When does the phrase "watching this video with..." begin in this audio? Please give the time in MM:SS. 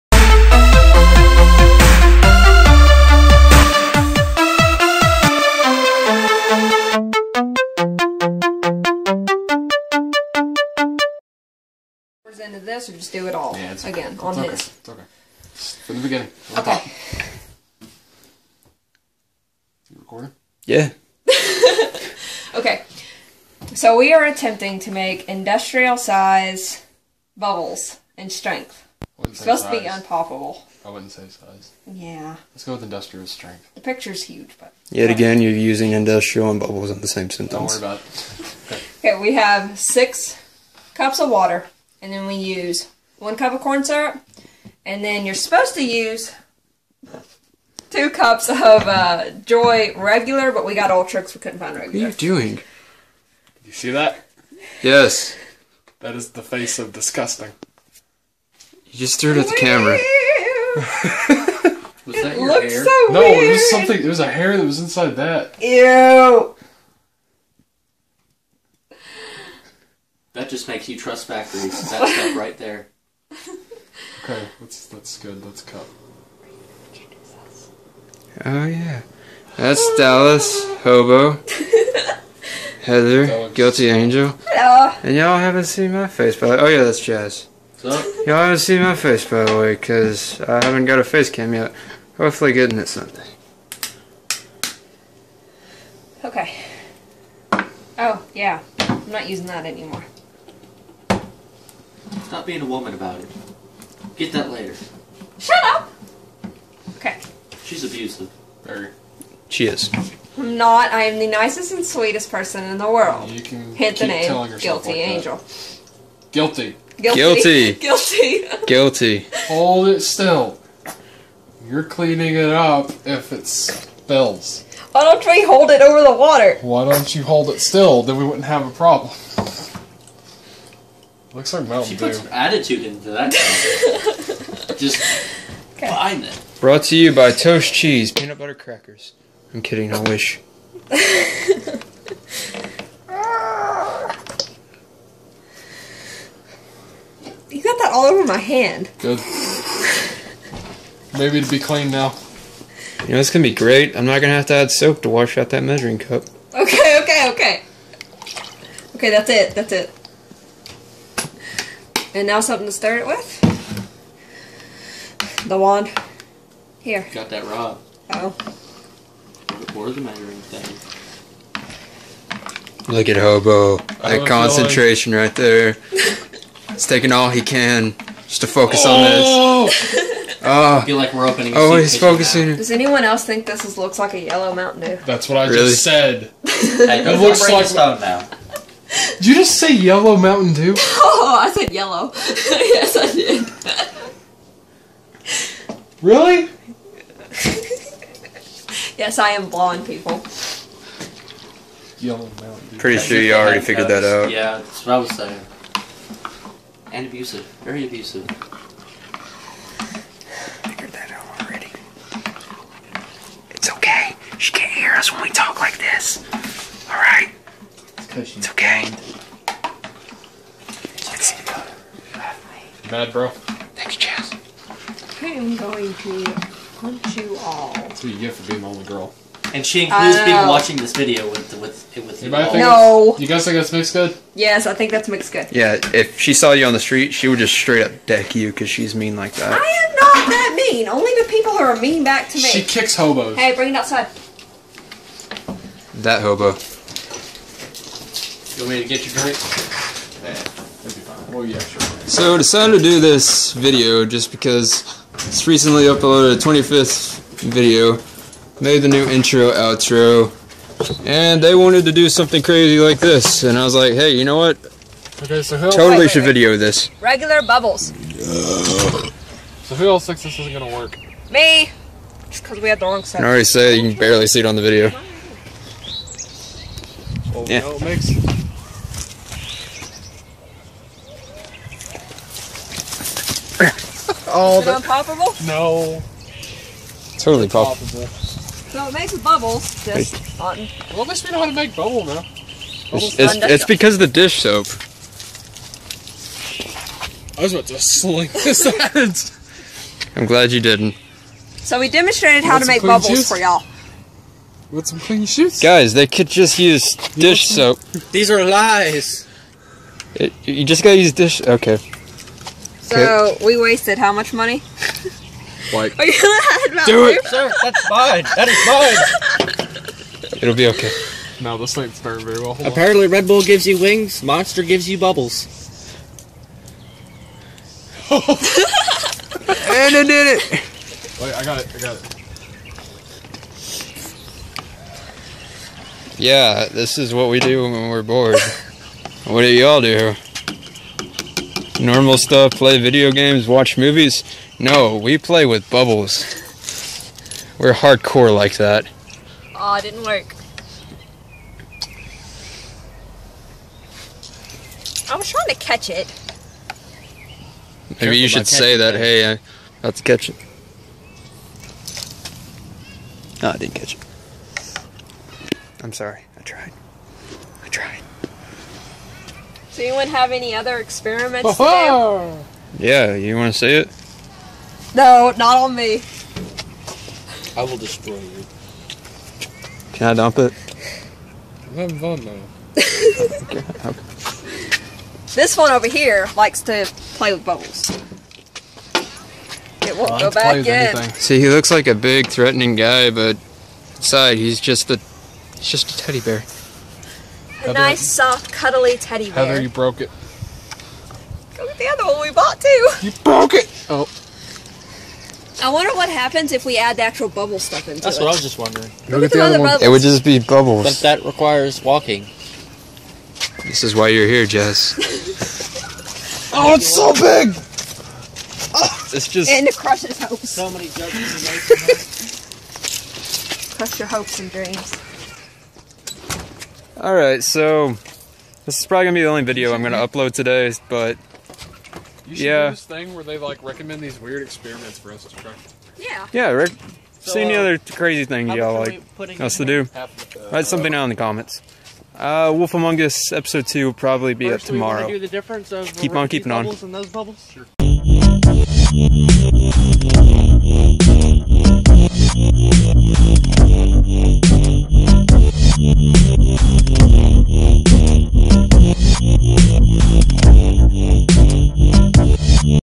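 03:50.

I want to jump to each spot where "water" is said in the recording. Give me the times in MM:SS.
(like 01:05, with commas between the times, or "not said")
00:41, 02:06.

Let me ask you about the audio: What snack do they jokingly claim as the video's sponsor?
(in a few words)
Toast Cheese Peanut Butter Crackers.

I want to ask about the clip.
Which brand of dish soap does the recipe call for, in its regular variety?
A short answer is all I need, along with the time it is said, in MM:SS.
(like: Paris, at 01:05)
Joy, at 00:49.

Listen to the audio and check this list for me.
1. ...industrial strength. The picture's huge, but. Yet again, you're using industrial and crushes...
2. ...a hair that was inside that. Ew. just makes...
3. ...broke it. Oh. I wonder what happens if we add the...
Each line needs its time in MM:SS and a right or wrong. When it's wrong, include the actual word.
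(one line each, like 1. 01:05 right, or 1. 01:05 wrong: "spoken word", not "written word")
1. 00:32 wrong: "bubbles", not "crushes"
2. 01:04 right
3. 06:43 right.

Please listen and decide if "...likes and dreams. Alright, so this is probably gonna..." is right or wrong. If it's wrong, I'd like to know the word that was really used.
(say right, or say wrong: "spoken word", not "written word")
wrong: "hopes", not "likes".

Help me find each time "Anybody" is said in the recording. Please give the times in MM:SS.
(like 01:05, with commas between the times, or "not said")
03:52.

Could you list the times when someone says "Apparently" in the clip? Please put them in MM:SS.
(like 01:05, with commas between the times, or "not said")
05:22.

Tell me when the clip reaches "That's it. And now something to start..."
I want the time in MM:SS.
02:39.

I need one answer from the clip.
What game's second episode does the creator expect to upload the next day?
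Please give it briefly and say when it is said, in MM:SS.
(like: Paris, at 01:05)
Wolf Among Us, at 07:22.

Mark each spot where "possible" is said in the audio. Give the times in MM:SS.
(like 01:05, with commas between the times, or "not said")
04:47.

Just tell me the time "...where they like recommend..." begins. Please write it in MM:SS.
07:13.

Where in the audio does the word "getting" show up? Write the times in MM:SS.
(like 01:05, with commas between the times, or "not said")
01:32.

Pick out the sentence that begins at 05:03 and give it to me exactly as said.
for y'all with some clean shoes.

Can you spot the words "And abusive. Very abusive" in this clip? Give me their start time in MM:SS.
03:26.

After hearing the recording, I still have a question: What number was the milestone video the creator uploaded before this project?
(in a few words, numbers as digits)
25th.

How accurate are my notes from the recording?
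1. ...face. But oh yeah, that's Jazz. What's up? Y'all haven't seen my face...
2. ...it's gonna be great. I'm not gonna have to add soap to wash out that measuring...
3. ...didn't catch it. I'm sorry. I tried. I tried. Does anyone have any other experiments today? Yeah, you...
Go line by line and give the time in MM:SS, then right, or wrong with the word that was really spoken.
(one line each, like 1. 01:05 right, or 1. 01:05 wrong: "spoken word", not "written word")
1. 01:26 right
2. 02:33 right
3. 06:03 right.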